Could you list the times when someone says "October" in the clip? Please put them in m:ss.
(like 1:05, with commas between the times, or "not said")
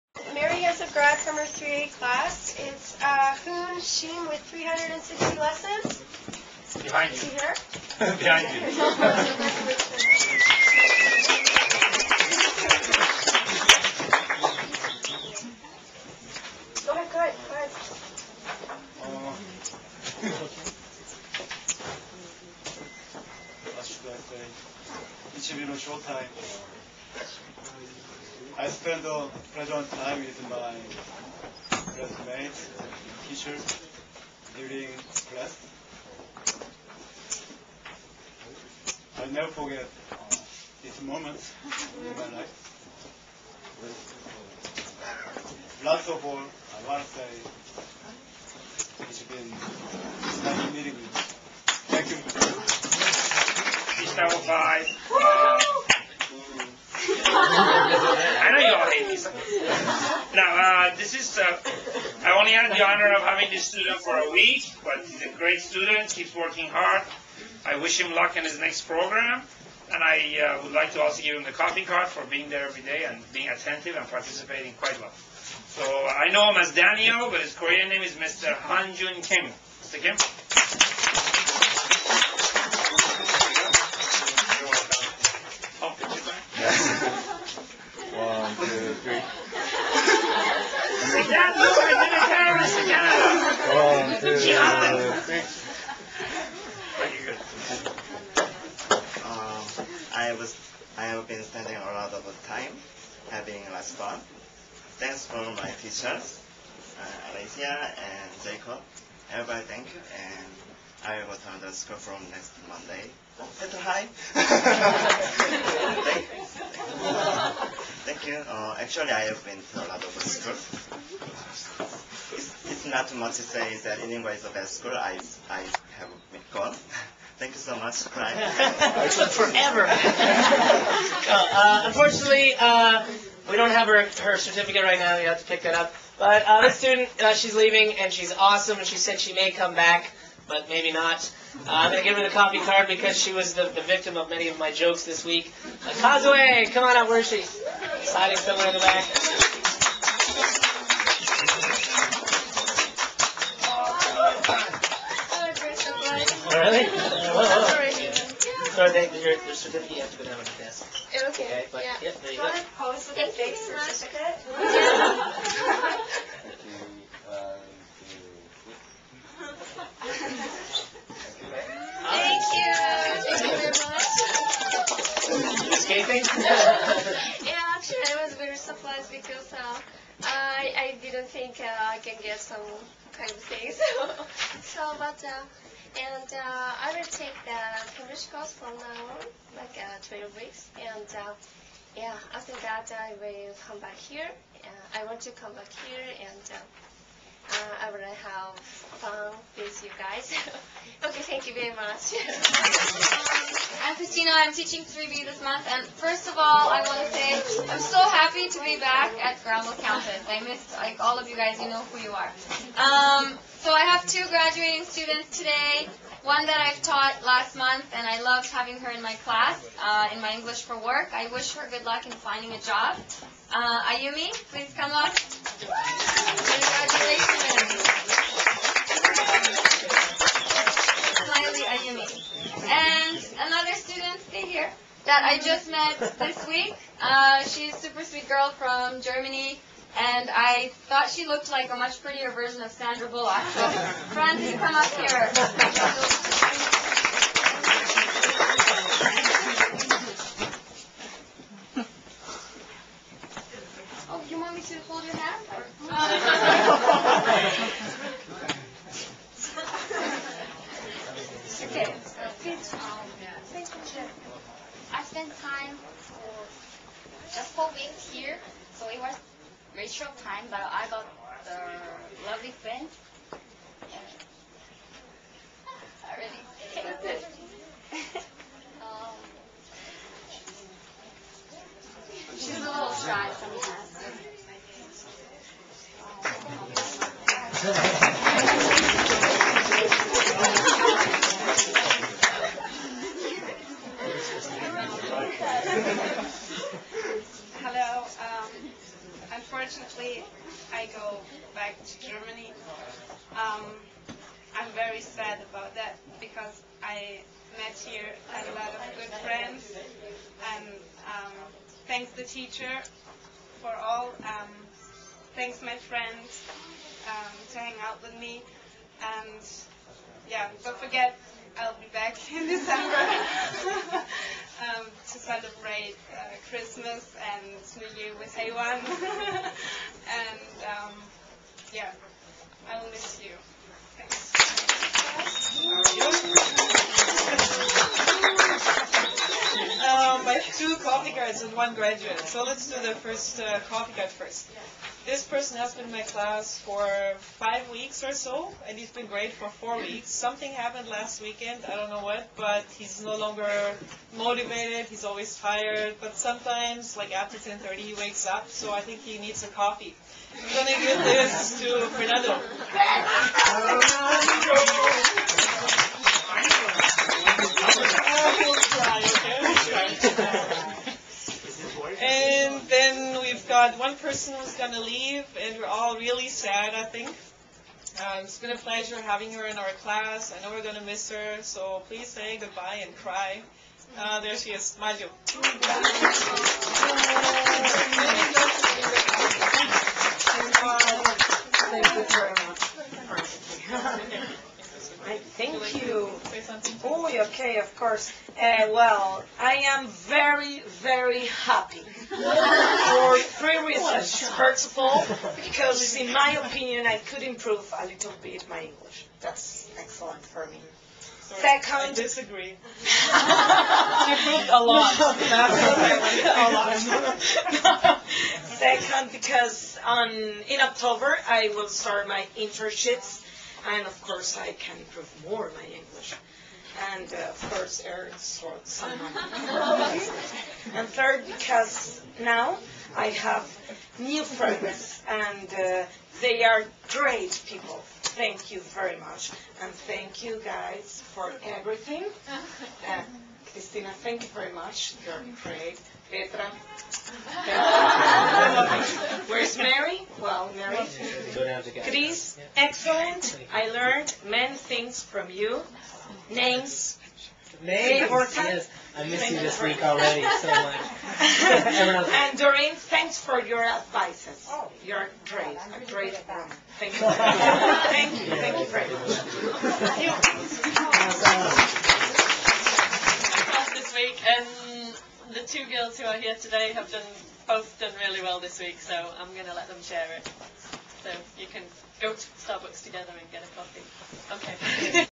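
7:00.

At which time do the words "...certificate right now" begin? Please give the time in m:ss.
2:14.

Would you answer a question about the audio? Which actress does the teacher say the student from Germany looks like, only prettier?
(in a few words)
Sandra Bullock.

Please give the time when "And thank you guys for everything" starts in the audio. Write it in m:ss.
7:19.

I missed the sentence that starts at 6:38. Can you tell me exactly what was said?
Uh, well, I am very, very happy for three reasons.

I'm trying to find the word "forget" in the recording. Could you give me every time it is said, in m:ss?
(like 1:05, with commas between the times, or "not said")
0:39, 5:20.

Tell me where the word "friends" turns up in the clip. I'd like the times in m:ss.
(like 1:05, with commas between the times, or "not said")
4:32, 5:09, 5:15, 7:14.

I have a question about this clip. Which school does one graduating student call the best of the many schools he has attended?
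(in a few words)
inlingua.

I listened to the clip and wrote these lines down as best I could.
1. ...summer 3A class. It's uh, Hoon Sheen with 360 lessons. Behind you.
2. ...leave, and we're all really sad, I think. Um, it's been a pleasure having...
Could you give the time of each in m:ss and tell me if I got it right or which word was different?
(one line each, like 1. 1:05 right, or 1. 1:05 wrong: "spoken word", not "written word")
1. 0:01 right
2. 6:14 right.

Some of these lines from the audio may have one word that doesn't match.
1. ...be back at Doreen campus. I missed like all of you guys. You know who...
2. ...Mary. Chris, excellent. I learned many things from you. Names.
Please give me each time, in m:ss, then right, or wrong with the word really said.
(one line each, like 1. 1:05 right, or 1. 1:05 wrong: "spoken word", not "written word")
1. 3:28 wrong: "Granville", not "Doreen"
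2. 7:30 right.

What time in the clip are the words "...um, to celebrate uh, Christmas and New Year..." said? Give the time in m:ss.
5:24.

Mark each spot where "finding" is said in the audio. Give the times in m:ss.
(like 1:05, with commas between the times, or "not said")
3:42.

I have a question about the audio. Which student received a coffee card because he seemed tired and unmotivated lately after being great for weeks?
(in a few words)
Fernando.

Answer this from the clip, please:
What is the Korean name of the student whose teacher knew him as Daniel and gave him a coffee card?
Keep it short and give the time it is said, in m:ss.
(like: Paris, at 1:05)
Hanjun Kim, at 1:18.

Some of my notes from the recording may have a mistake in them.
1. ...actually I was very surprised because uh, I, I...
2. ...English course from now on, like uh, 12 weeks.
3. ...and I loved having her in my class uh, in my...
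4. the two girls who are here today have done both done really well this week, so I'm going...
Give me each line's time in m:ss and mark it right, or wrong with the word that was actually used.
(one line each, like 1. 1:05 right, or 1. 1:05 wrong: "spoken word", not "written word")
1. 2:57 right
2. 3:08 right
3. 3:37 right
4. 7:55 right.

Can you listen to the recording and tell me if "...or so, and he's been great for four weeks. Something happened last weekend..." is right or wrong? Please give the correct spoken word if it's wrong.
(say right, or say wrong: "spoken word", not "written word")
right.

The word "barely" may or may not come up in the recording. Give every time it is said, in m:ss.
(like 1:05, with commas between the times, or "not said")
not said.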